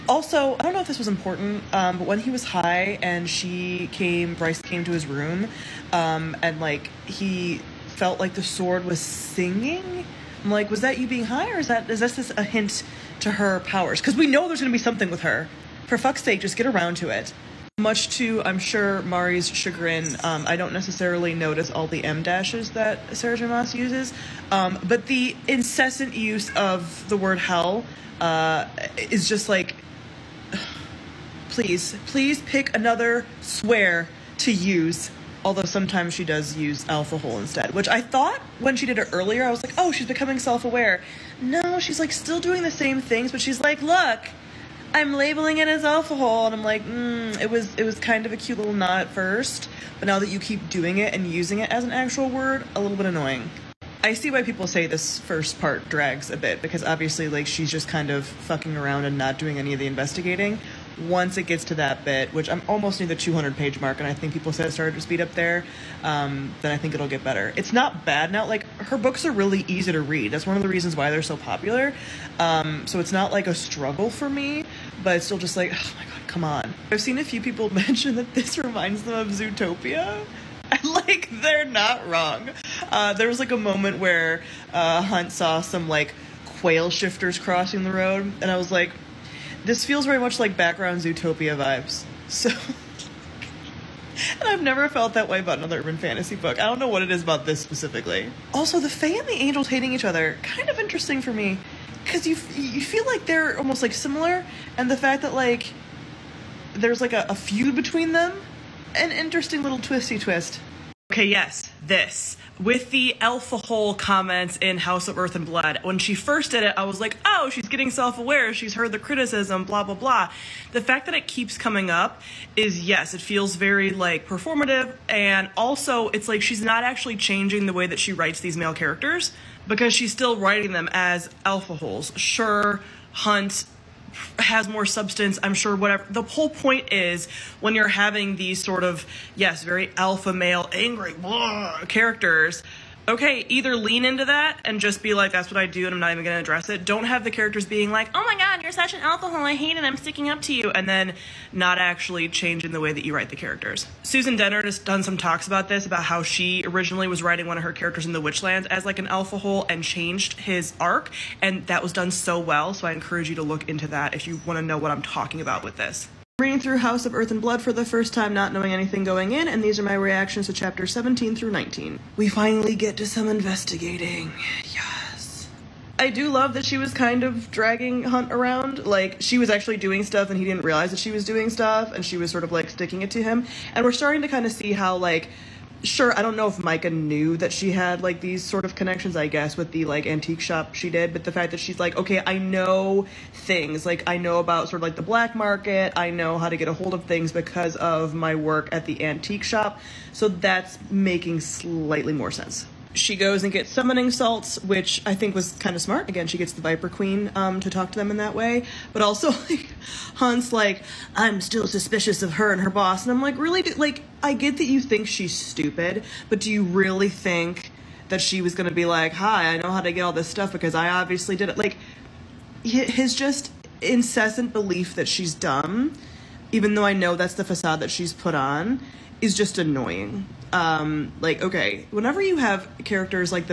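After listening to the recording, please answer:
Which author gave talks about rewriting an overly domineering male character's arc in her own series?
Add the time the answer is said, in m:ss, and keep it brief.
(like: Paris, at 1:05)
Susan Dennard, at 2:34.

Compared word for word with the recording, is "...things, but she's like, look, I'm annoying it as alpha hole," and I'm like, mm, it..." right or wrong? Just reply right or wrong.
wrong.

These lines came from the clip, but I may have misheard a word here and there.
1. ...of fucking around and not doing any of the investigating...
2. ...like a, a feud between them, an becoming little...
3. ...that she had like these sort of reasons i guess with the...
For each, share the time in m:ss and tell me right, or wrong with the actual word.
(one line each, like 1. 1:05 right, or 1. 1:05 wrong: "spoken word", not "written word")
1. 0:58 right
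2. 1:47 wrong: "interesting", not "becoming"
3. 3:07 wrong: "connections", not "reasons".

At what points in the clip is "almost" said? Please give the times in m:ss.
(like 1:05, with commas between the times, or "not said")
1:02, 1:43.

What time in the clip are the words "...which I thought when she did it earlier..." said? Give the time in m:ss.
0:37.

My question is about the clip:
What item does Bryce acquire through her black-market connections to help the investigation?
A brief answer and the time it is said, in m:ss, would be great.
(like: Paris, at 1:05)
summoning salts, at 3:23.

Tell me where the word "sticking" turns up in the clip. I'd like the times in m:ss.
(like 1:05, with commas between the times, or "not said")
2:29, 3:02.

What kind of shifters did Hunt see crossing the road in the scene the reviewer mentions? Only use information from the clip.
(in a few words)
quail shifters.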